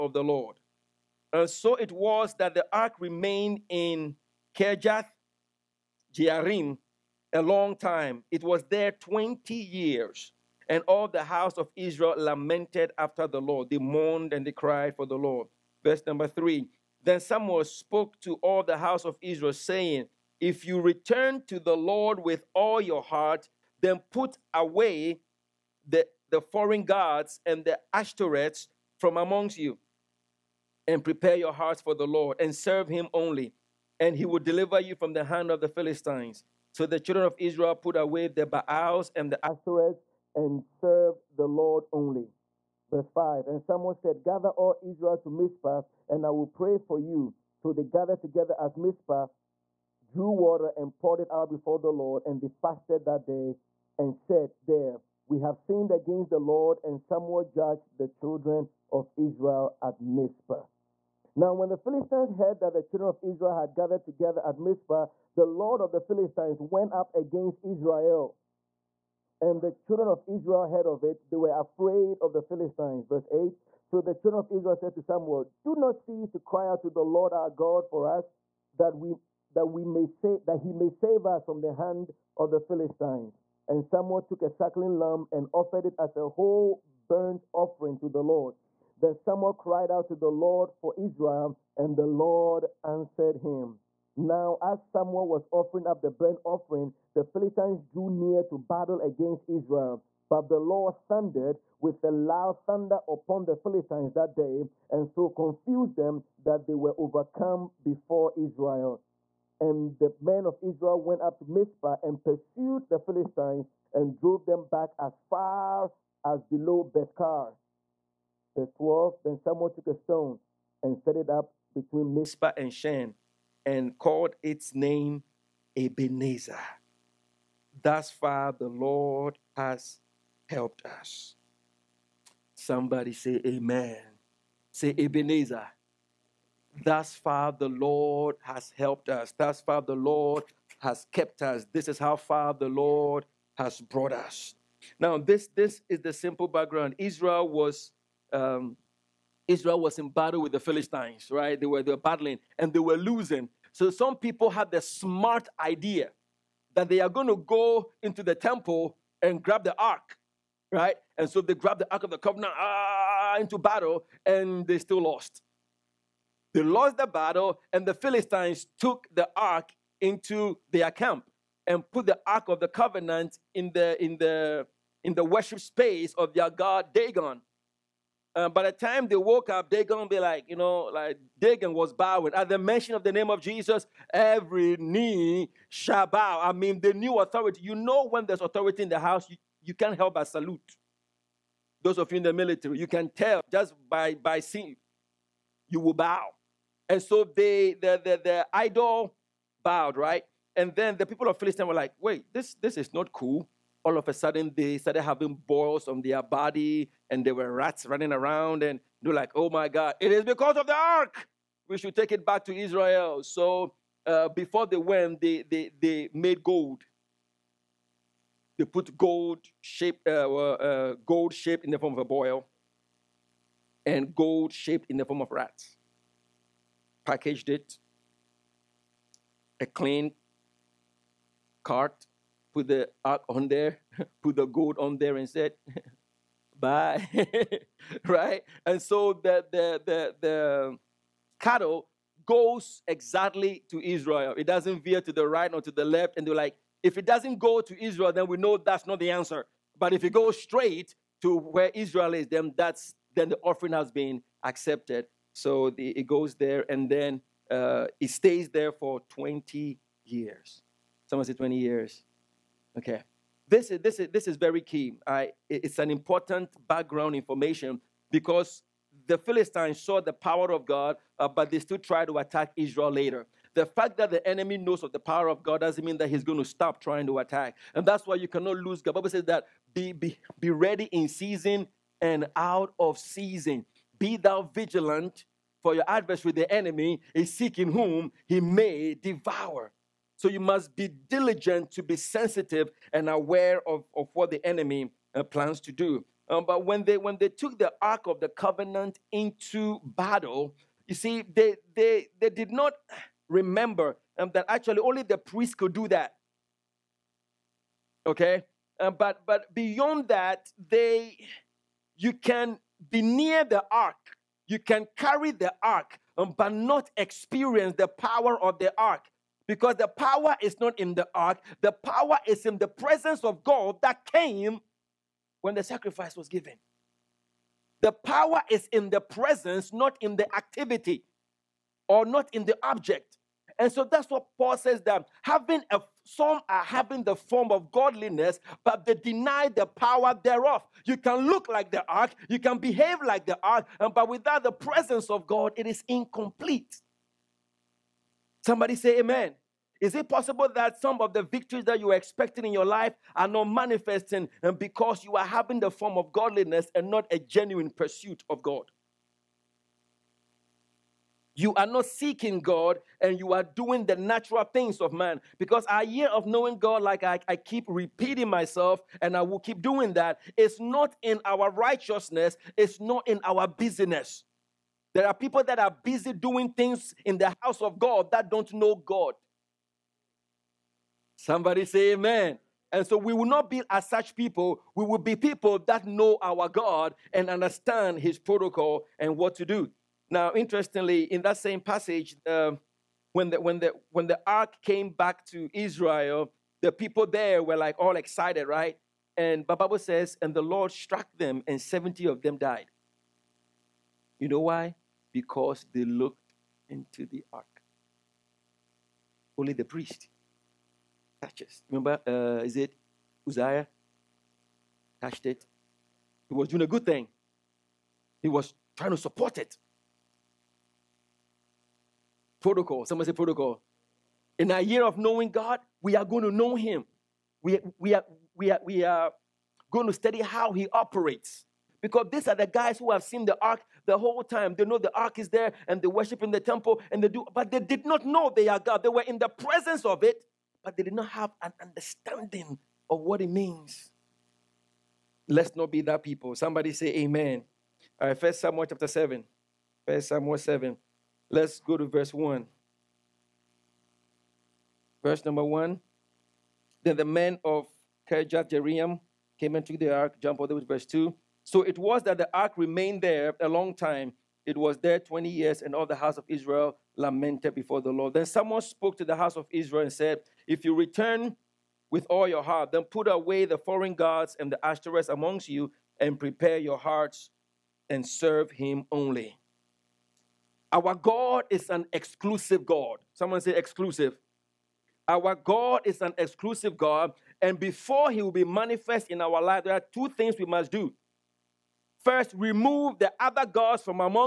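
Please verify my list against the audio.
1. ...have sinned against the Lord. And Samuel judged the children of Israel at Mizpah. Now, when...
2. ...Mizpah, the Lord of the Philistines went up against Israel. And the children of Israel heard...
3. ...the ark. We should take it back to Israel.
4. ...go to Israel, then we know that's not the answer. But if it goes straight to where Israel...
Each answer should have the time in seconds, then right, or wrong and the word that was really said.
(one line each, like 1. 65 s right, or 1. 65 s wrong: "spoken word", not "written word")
1. 55 s right
2. 64 s right
3. 210 s right
4. 247 s right.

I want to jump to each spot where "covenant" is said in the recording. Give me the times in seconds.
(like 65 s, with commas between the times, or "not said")
162 s, 172 s, 298 s.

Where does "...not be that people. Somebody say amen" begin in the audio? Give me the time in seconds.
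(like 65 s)
445 s.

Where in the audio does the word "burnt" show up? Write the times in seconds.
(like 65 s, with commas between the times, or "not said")
87 s, 96 s.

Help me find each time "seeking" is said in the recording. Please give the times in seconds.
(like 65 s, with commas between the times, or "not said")
287 s, 361 s.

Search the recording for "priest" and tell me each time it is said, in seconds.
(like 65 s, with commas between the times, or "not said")
305 s, 409 s.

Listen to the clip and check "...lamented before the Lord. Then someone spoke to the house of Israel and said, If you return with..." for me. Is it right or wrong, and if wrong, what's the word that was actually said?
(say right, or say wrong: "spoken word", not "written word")
right.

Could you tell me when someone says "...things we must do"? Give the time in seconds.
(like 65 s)
490 s.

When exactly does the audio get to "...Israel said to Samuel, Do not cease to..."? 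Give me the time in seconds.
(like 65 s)
74 s.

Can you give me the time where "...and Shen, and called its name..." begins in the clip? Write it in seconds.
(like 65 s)
122 s.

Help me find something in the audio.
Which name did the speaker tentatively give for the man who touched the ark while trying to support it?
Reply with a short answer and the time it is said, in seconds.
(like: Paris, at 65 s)
Uzziah, at 413 s.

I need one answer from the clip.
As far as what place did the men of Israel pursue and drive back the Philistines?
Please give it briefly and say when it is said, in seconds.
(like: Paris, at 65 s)
Bethkar, at 116 s.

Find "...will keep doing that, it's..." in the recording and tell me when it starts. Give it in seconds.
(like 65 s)
369 s.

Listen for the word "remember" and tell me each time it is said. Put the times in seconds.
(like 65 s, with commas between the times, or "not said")
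303 s, 411 s.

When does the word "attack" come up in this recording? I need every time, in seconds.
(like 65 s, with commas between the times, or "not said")
272 s, 277 s.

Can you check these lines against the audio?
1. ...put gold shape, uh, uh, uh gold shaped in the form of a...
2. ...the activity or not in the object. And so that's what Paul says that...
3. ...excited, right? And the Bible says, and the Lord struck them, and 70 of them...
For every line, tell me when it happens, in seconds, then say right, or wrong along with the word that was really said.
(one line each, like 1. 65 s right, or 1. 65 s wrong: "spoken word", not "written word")
1. 218 s right
2. 330 s right
3. 397 s right.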